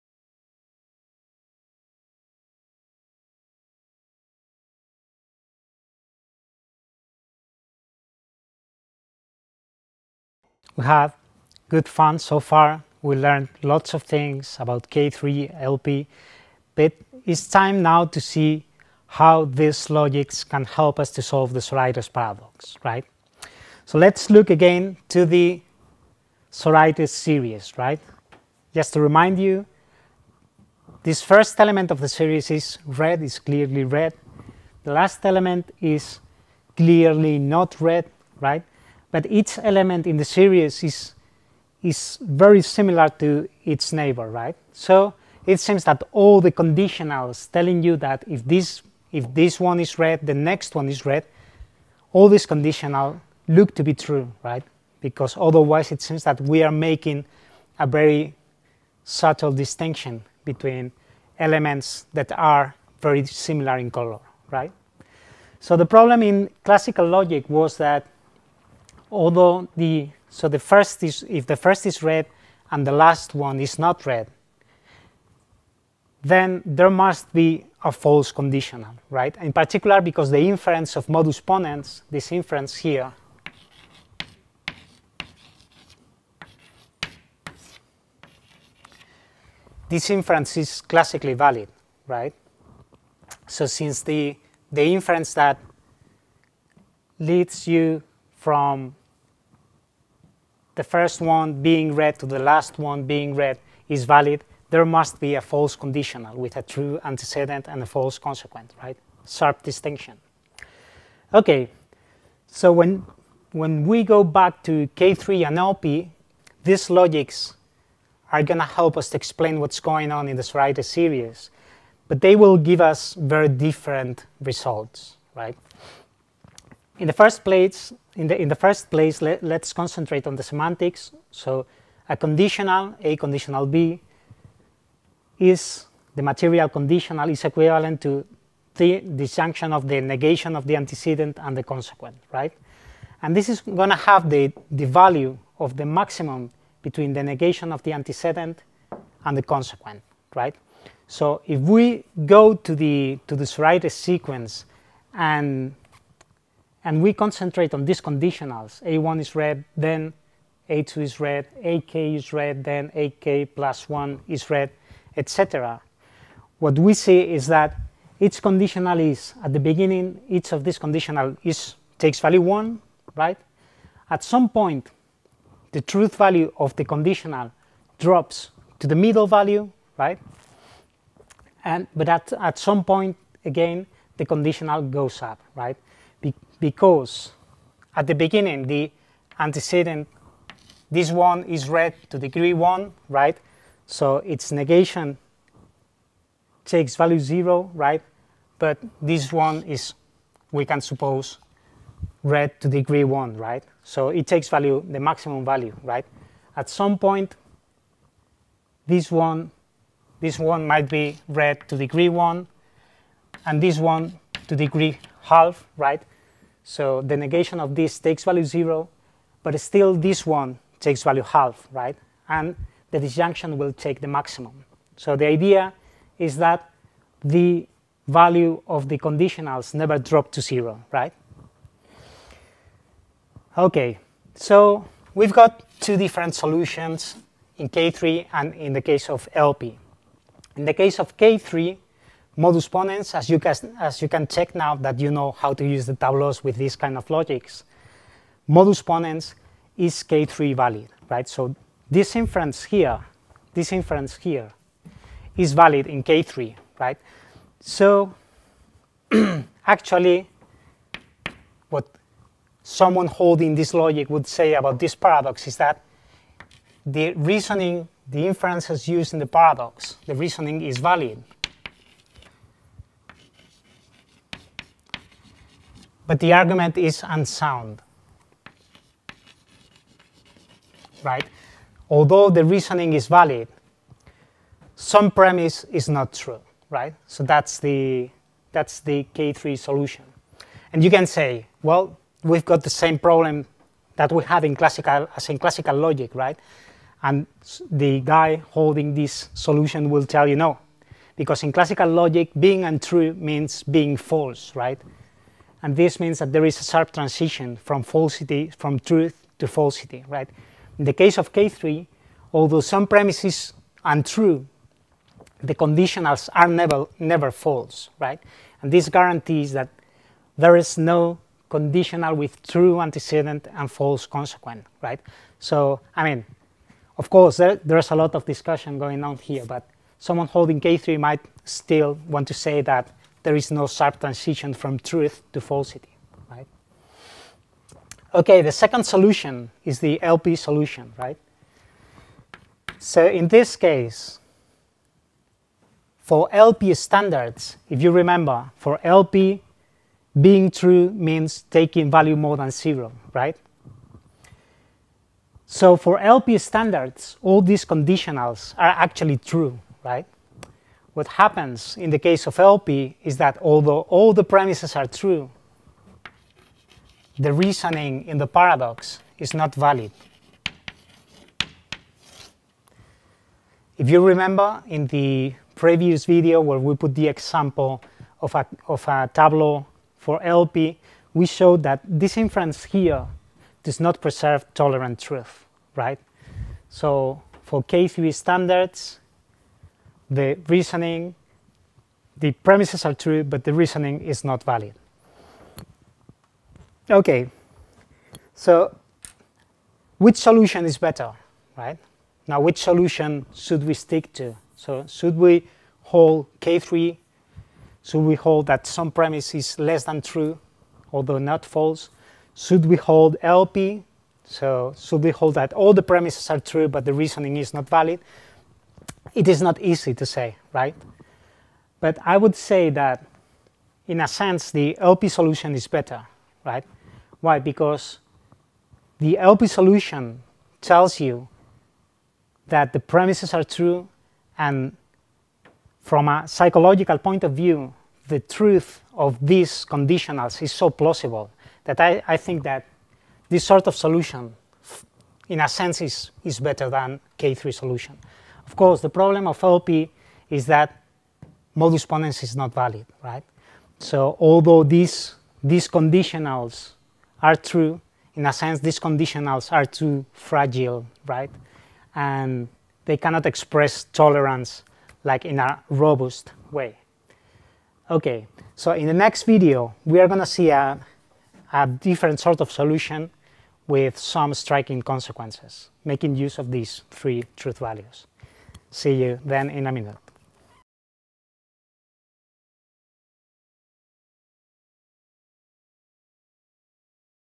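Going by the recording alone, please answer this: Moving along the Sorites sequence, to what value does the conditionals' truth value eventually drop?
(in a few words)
the middle value.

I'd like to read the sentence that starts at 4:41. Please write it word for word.
Although the reasoning is valid, some premise is not true, right?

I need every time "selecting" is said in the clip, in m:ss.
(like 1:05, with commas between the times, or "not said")
not said.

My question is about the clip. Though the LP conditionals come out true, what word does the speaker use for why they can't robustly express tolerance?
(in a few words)
fragile.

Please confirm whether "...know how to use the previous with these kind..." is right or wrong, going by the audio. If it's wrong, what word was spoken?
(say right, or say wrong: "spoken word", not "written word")
wrong: "tableaus", not "previous".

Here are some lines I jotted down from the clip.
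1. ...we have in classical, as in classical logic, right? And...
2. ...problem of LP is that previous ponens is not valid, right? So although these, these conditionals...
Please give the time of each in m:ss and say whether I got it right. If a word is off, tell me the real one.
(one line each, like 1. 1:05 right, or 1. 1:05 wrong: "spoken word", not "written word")
1. 4:54 right
2. 7:28 wrong: "modus", not "previous".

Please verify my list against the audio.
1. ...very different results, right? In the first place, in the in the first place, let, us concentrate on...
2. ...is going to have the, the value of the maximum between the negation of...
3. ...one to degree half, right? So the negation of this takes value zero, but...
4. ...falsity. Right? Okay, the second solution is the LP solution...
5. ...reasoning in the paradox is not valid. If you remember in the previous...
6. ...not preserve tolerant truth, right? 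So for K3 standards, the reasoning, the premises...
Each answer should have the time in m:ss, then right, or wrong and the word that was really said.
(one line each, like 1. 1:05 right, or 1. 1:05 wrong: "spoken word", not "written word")
1. 2:03 right
2. 2:23 right
3. 3:33 right
4. 5:35 right
5. 6:07 right
6. 6:23 right.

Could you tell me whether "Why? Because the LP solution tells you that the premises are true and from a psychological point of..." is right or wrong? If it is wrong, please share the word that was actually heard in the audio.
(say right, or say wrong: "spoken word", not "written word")
right.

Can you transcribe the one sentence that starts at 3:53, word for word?
Okay, so we've got two different solutions in K3 and in the case of LP.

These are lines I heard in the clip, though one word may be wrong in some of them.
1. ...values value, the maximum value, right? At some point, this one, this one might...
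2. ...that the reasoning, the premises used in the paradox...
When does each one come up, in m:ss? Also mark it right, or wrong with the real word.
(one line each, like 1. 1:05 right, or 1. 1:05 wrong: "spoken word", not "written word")
1. 3:24 wrong: "takes", not "values"
2. 4:25 wrong: "inferences", not "premises".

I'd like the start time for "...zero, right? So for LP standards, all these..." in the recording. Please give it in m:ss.
5:52.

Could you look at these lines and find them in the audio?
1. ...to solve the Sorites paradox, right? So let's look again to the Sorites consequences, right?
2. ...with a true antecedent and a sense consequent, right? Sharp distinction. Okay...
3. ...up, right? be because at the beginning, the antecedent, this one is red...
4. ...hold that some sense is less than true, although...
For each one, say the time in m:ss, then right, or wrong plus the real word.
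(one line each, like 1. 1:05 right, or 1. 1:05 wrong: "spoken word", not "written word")
1. 0:21 wrong: "series", not "consequences"
2. 1:46 wrong: "false", not "sense"
3. 3:05 right
4. 6:48 wrong: "premise", not "sense".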